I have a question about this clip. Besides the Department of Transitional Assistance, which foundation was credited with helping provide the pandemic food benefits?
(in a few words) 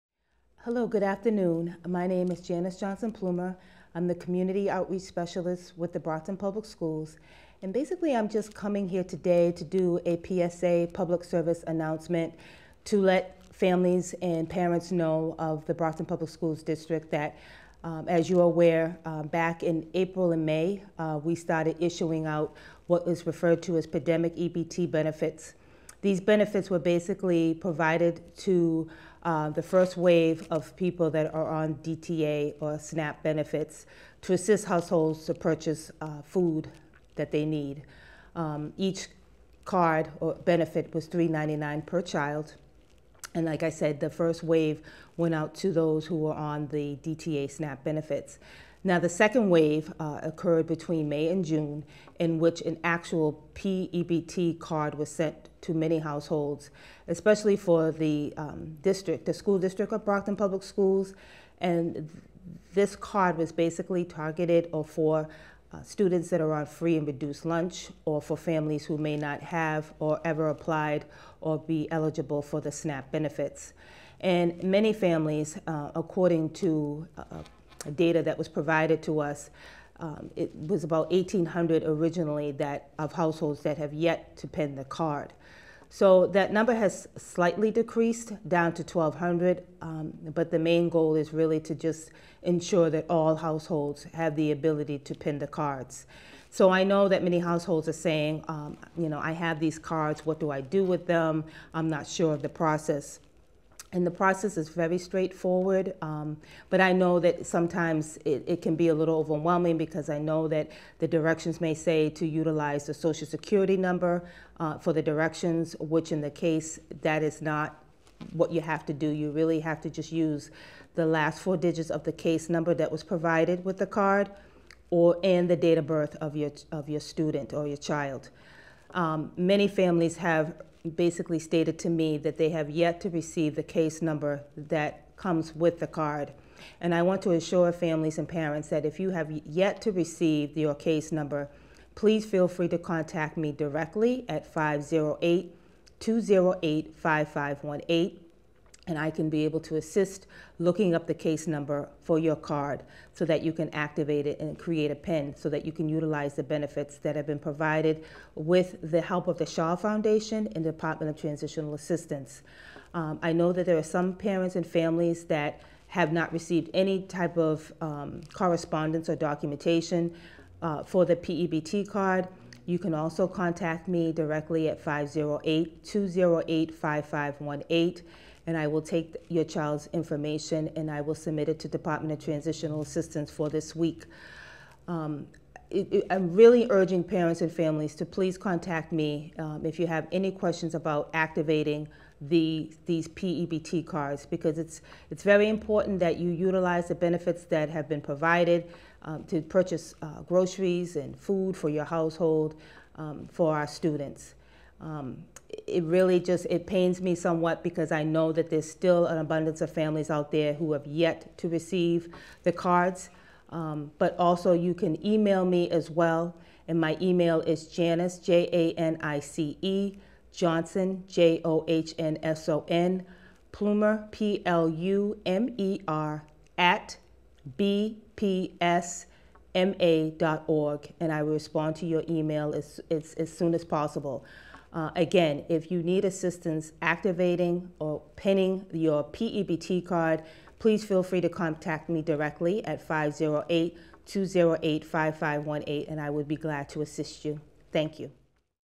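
Shaw Foundation.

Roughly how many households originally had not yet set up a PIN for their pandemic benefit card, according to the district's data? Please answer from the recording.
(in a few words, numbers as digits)
1,800.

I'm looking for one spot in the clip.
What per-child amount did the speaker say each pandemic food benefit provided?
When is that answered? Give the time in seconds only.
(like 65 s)
41 s.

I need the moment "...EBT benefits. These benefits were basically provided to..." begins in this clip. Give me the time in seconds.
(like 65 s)
24 s.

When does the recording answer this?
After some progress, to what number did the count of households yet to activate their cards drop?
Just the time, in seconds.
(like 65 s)
88 s.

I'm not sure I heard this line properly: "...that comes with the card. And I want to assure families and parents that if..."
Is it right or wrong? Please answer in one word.
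right.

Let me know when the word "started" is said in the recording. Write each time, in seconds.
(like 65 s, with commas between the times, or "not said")
21 s.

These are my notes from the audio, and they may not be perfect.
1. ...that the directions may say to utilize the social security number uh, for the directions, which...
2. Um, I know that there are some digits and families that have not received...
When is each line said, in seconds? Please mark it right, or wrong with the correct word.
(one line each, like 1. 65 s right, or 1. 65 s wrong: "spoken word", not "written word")
1. 110 s right
2. 162 s wrong: "parents", not "digits".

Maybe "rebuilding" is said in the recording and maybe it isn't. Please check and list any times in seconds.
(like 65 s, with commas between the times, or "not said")
not said.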